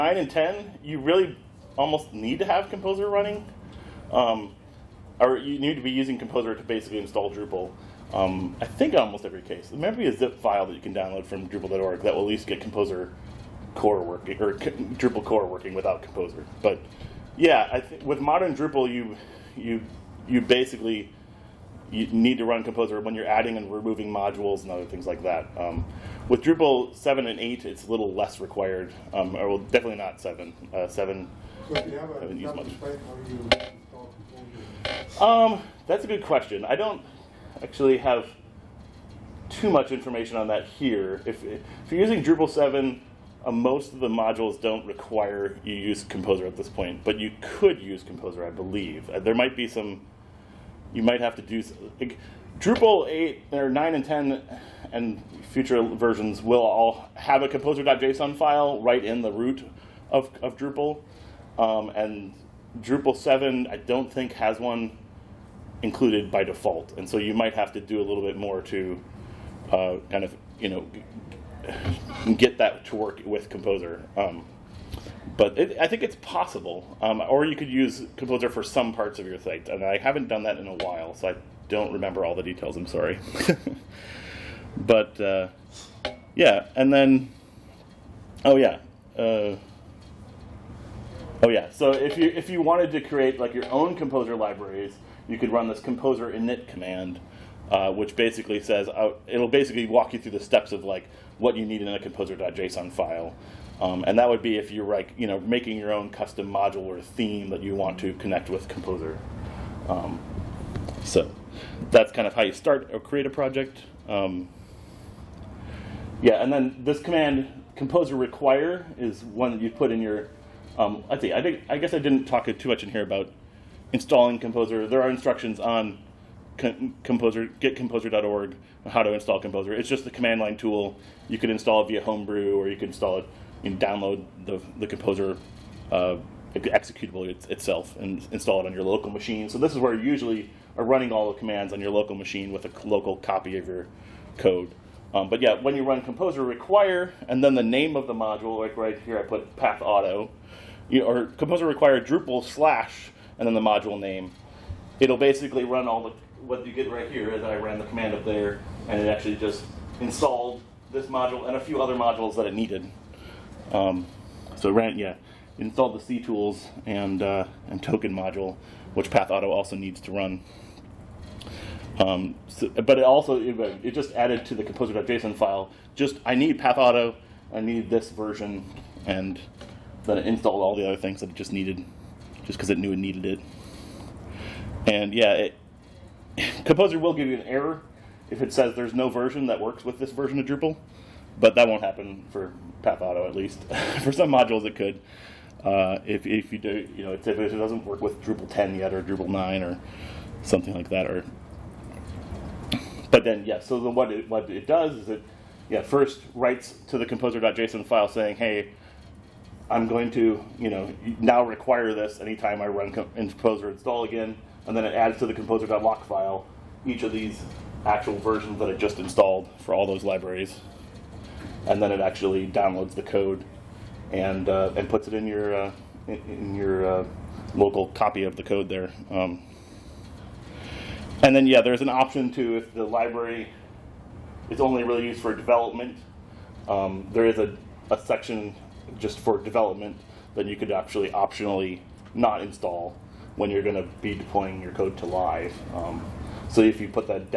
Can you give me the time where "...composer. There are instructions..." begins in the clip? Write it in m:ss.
2:04.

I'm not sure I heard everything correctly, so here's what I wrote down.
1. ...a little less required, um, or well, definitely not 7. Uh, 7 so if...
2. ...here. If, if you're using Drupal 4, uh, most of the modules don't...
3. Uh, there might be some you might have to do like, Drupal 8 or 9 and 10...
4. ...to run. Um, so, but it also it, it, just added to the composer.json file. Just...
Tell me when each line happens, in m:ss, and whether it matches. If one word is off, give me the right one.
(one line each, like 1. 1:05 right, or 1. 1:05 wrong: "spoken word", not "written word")
1. 0:27 right
2. 0:40 wrong: "7", not "4"
3. 0:49 right
4. 2:50 right.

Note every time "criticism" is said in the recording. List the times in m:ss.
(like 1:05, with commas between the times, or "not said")
not said.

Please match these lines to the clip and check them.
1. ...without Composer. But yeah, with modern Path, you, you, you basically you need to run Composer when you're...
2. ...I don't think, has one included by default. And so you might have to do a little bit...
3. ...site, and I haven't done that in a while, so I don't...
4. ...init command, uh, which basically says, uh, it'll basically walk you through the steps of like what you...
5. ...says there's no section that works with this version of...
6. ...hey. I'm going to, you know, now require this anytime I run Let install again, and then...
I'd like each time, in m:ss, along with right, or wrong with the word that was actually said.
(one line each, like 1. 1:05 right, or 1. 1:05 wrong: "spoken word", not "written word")
1. 0:15 wrong: "Drupal", not "Path"
2. 1:03 right
3. 1:19 right
4. 1:36 right
5. 3:08 wrong: "version", not "section"
6. 3:28 wrong: "Composer", not "Let".